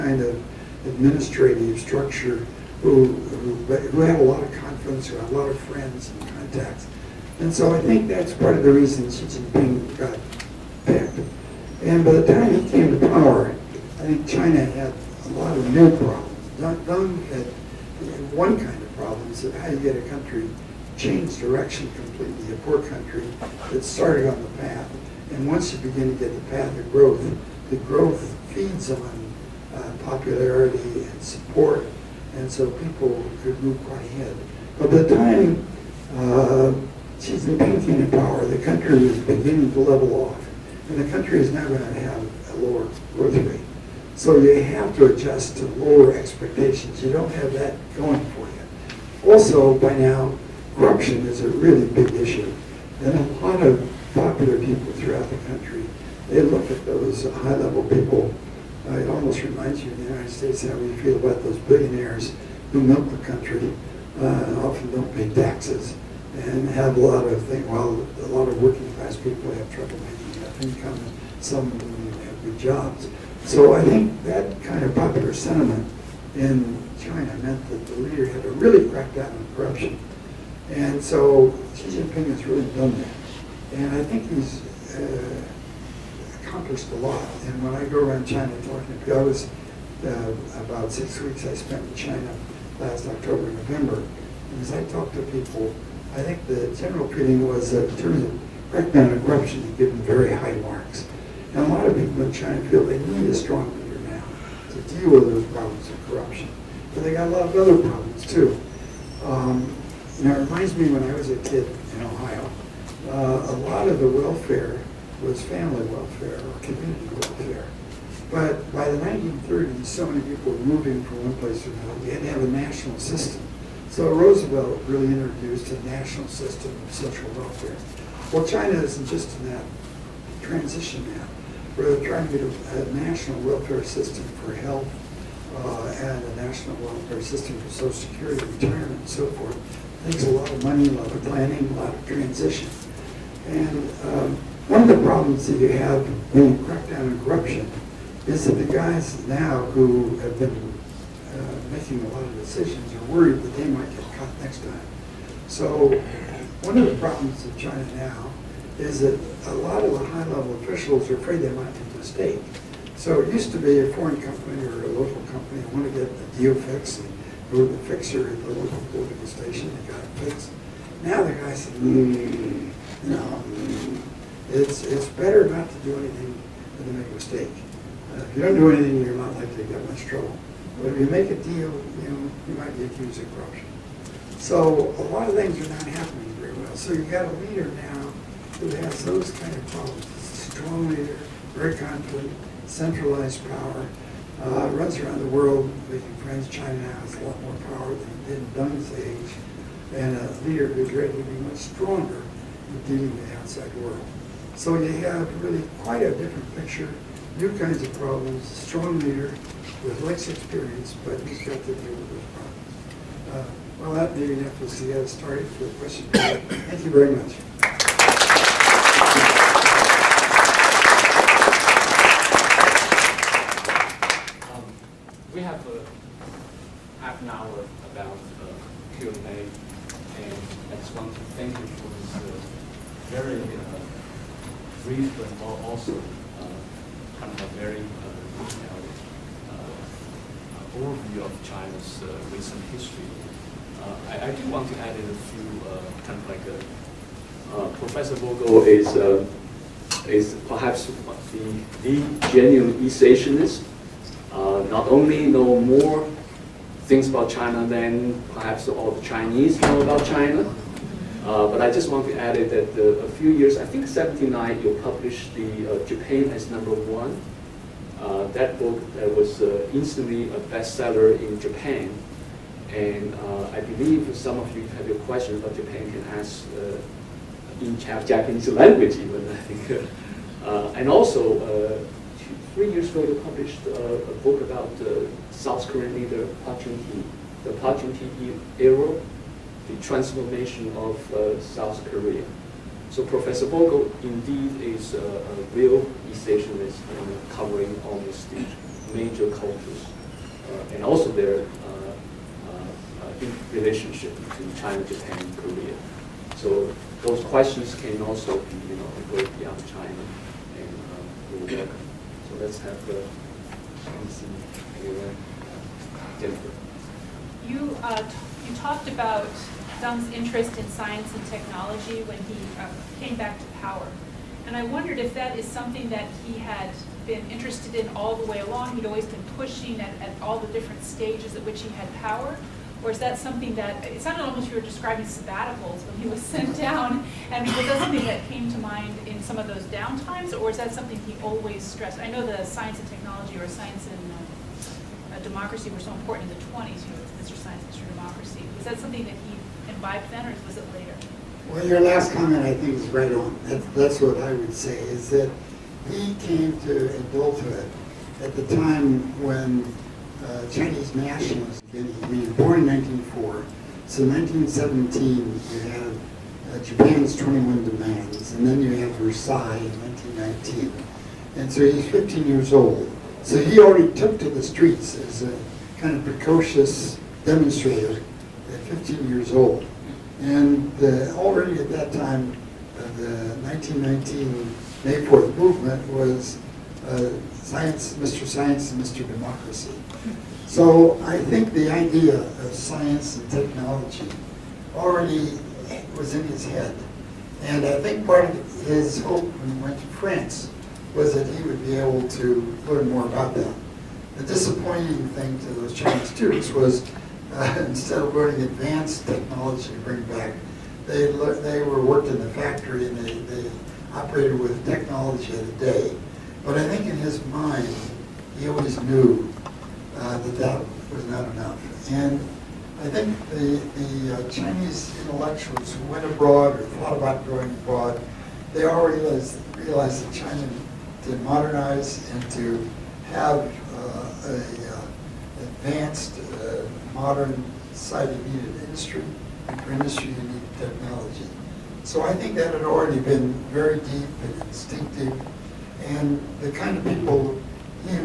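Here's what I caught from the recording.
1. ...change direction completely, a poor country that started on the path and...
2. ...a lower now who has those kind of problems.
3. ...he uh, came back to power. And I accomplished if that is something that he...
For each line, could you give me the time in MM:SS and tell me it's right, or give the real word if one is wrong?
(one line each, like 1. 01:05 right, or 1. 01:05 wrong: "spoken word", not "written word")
1. 00:20 right
2. 03:07 wrong: "leader", not "lower"
3. 05:22 wrong: "wondered", not "accomplished".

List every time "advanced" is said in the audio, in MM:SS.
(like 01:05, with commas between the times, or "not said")
06:48, 07:15.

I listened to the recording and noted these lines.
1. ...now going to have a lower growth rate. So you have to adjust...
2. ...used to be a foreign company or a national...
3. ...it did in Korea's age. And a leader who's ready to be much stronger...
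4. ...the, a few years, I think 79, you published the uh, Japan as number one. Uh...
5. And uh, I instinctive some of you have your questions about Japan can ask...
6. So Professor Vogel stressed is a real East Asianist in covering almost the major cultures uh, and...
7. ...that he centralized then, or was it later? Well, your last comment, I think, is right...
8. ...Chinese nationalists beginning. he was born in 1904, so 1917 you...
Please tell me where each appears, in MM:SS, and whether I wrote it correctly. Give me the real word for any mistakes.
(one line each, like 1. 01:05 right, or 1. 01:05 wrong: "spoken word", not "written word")
1. 00:41 right
2. 02:43 wrong: "local", not "national"
3. 03:18 wrong: "Deng", not "Korea"
4. 04:22 right
5. 04:32 wrong: "believe", not "instinctive"
6. 04:52 wrong: "indeed", not "stressed"
7. 05:49 wrong: "imbibed", not "centralized"
8. 06:00 right.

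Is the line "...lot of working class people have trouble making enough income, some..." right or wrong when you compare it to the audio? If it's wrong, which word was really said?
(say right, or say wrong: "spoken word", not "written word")
right.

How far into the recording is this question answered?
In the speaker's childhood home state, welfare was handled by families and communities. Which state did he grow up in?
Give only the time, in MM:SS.
01:52.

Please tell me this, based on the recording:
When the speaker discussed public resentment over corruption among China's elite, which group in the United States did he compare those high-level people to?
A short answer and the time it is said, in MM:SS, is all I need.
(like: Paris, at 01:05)
billionaires, at 01:01.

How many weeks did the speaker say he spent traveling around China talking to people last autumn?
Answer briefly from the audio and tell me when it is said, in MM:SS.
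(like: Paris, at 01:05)
6, at 01:30.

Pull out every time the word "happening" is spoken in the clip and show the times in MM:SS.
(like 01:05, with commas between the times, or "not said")
03:05.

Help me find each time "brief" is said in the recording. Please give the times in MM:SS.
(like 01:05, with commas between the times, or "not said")
03:54.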